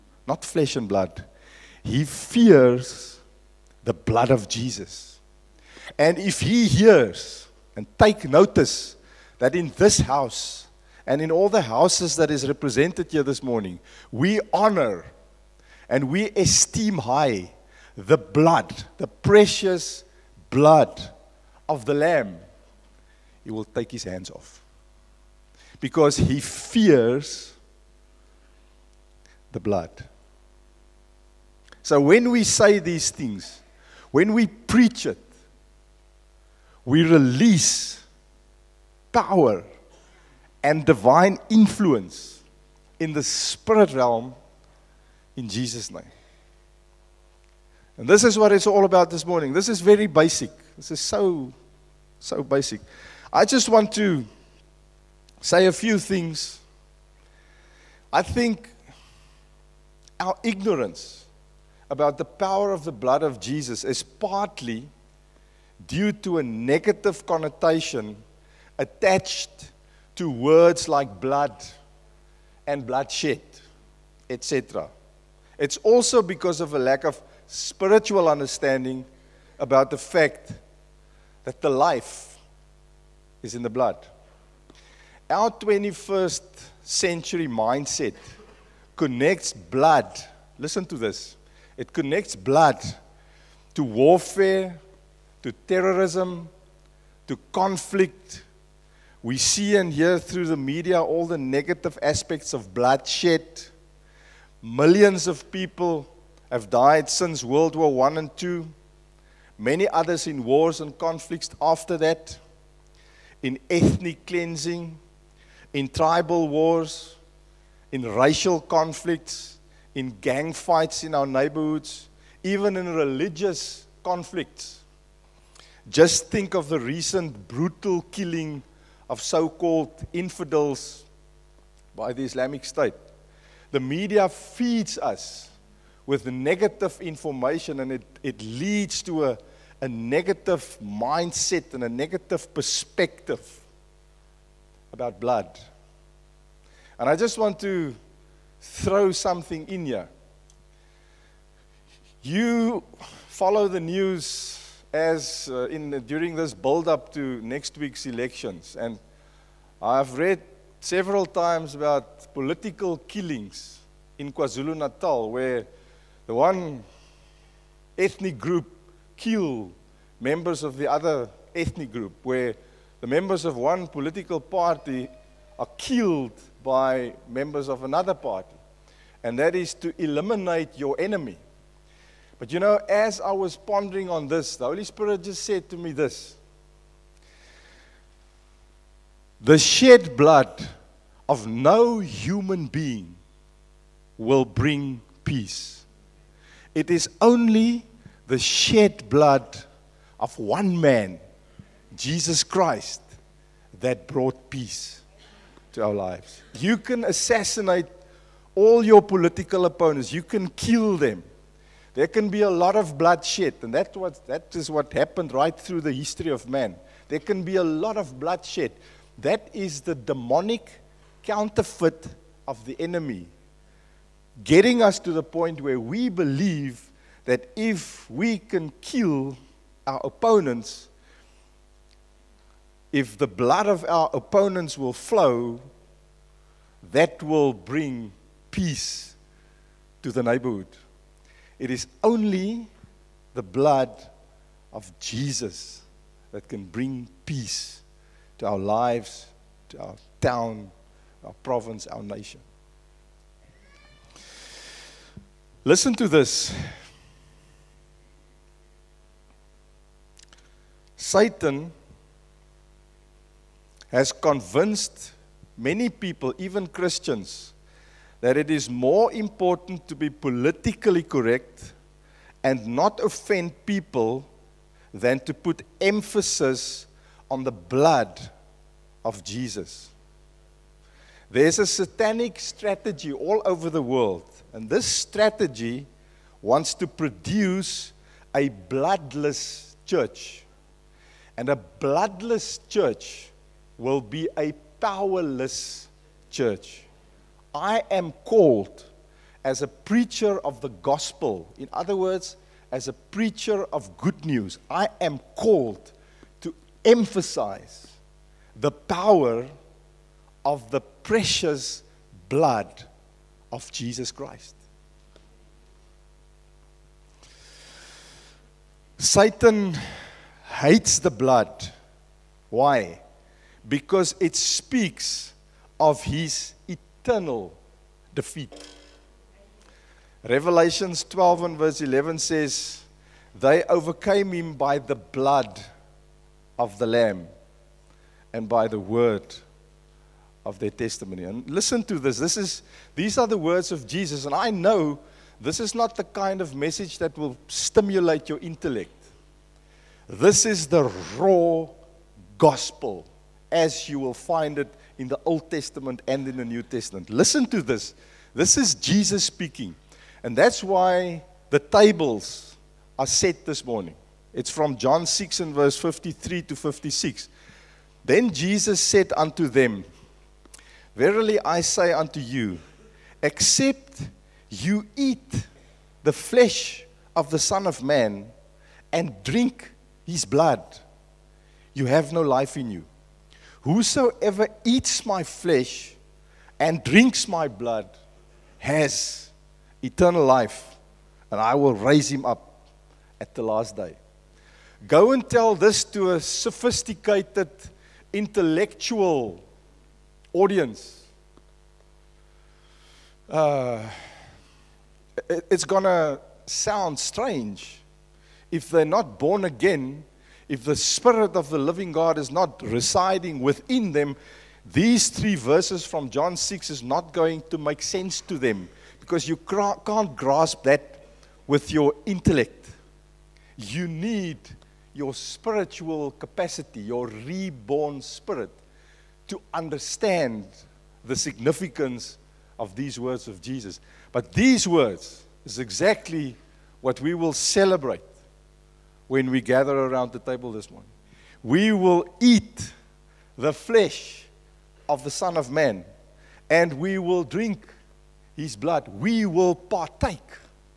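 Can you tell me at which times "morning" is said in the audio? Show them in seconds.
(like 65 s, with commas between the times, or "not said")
13 s, 49 s, 363 s, 440 s.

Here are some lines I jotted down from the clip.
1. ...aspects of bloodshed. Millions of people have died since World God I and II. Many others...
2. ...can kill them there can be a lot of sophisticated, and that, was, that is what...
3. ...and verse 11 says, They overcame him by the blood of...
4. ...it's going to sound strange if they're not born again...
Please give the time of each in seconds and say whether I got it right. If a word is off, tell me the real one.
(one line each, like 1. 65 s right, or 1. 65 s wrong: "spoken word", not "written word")
1. 101 s wrong: "War", not "God"
2. 210 s wrong: "bloodshed", not "sophisticated"
3. 331 s right
4. 405 s right.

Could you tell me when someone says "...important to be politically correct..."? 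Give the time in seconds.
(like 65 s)
269 s.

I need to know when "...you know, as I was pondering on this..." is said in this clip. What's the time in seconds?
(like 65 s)
182 s.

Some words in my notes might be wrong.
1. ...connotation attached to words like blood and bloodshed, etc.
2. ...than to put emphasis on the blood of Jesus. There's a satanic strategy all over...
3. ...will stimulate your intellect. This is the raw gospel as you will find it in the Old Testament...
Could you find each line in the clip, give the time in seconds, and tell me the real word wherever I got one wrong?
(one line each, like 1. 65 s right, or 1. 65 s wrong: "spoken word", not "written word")
1. 67 s right
2. 274 s right
3. 347 s right.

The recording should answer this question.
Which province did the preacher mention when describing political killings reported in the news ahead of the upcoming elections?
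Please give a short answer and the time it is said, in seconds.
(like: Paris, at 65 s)
KwaZulu-Natal, at 164 s.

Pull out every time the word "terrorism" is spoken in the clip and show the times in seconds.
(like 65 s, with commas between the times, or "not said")
95 s.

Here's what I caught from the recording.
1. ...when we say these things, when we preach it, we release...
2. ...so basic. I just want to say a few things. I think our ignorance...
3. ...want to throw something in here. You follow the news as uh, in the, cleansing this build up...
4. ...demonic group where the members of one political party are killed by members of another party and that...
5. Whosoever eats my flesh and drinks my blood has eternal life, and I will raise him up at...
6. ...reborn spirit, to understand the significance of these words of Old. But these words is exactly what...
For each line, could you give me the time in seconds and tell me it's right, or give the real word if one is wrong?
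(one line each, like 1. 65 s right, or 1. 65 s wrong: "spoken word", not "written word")
1. 31 s right
2. 52 s right
3. 147 s wrong: "during", not "cleansing"
4. 171 s wrong: "ethnic", not "demonic"
5. 383 s right
6. 427 s wrong: "Jesus", not "Old".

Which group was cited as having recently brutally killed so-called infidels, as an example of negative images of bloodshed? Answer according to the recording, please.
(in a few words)
Islamic State.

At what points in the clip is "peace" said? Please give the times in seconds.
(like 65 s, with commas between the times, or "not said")
195 s, 204 s, 238 s, 247 s.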